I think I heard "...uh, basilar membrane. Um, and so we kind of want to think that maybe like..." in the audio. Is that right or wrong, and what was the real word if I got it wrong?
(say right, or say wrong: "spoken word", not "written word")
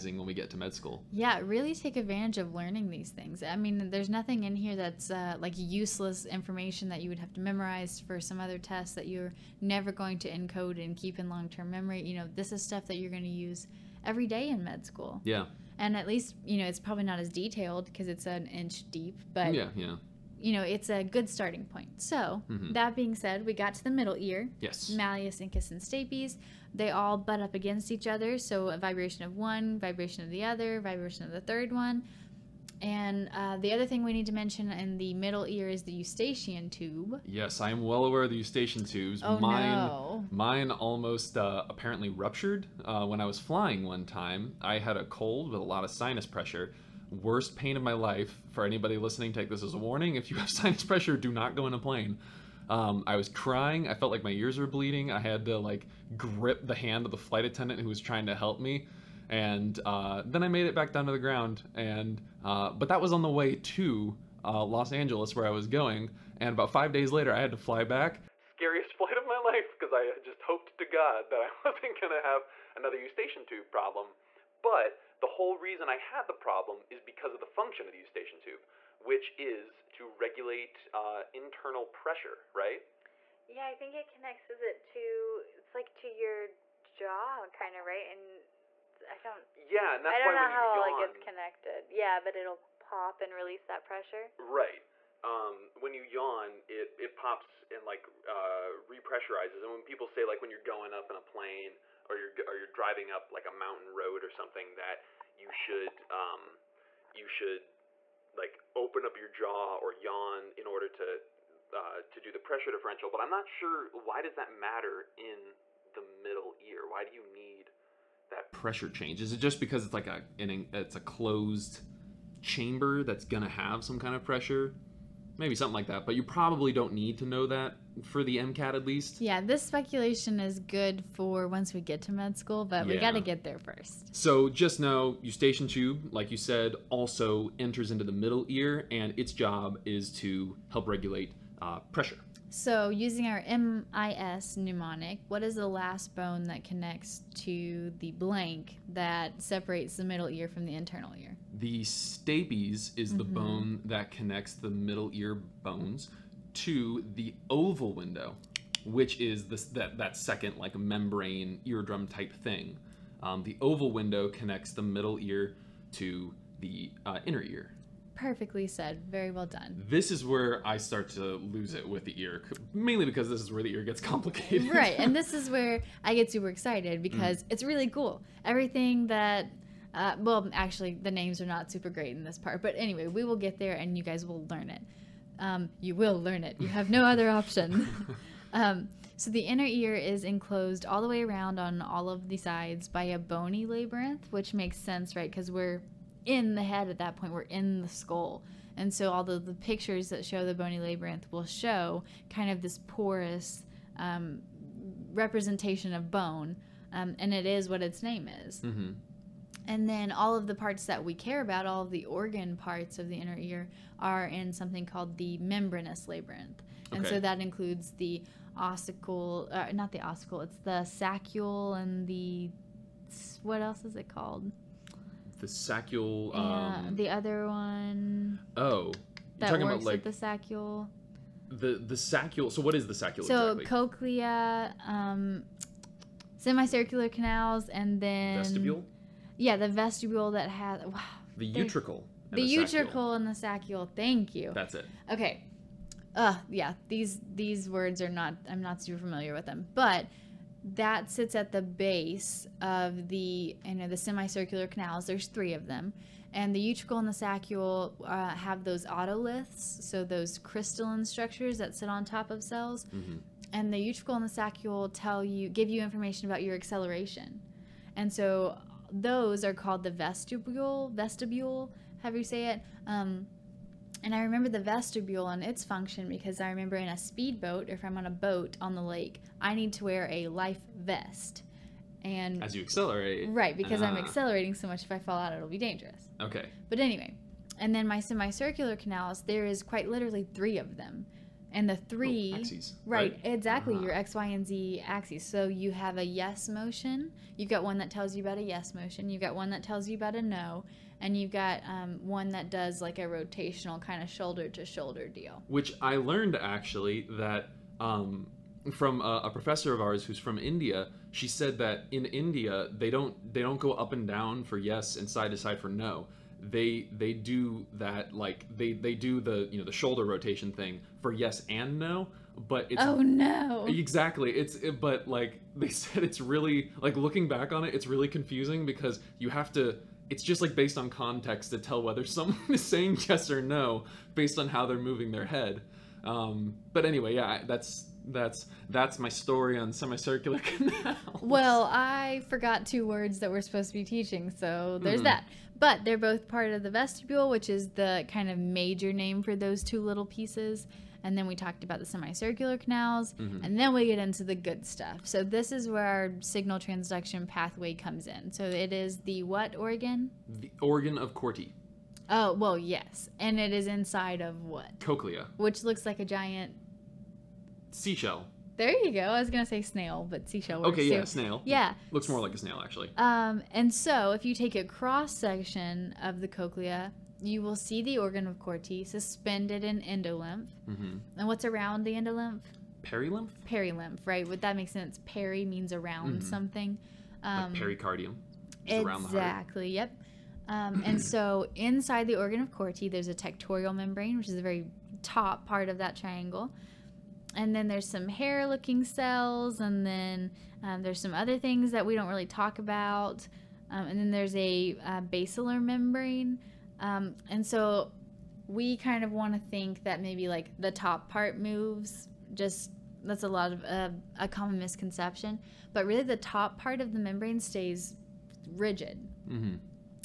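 right.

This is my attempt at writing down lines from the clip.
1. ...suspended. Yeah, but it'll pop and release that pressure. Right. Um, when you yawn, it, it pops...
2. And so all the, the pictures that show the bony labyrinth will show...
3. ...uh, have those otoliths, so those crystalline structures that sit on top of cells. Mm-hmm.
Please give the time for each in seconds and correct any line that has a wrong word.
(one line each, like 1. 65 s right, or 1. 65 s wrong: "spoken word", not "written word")
1. 91 s wrong: "connected", not "suspended"
2. 198 s right
3. 258 s right.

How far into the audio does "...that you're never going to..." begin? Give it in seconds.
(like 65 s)
8 s.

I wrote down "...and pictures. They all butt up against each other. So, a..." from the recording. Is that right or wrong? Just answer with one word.
wrong.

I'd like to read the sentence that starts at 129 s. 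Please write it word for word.
Yeah, this speculation is good for once we get to med school, but yeah.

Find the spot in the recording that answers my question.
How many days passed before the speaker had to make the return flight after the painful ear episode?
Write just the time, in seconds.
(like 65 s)
66 s.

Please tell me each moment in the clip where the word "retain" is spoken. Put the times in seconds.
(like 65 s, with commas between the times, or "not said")
not said.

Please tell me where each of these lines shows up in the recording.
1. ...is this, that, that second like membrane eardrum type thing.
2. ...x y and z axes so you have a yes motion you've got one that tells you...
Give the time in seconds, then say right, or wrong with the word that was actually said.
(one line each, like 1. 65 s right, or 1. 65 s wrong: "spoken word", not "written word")
1. 159 s right
2. 293 s right.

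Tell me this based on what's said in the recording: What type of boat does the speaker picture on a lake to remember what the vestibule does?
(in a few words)
speedboat.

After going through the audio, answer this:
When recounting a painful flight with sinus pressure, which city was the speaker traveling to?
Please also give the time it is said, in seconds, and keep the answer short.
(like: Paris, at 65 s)
Los Angeles, at 64 s.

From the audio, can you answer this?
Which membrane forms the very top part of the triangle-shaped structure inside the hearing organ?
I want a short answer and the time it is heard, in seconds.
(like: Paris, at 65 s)
tectorial membrane, at 393 s.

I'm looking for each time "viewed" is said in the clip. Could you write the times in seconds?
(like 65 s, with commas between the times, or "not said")
not said.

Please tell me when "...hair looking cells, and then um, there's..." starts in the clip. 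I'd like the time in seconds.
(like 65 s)
398 s.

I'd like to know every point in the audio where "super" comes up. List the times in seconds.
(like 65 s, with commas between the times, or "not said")
176 s, 181 s, 248 s.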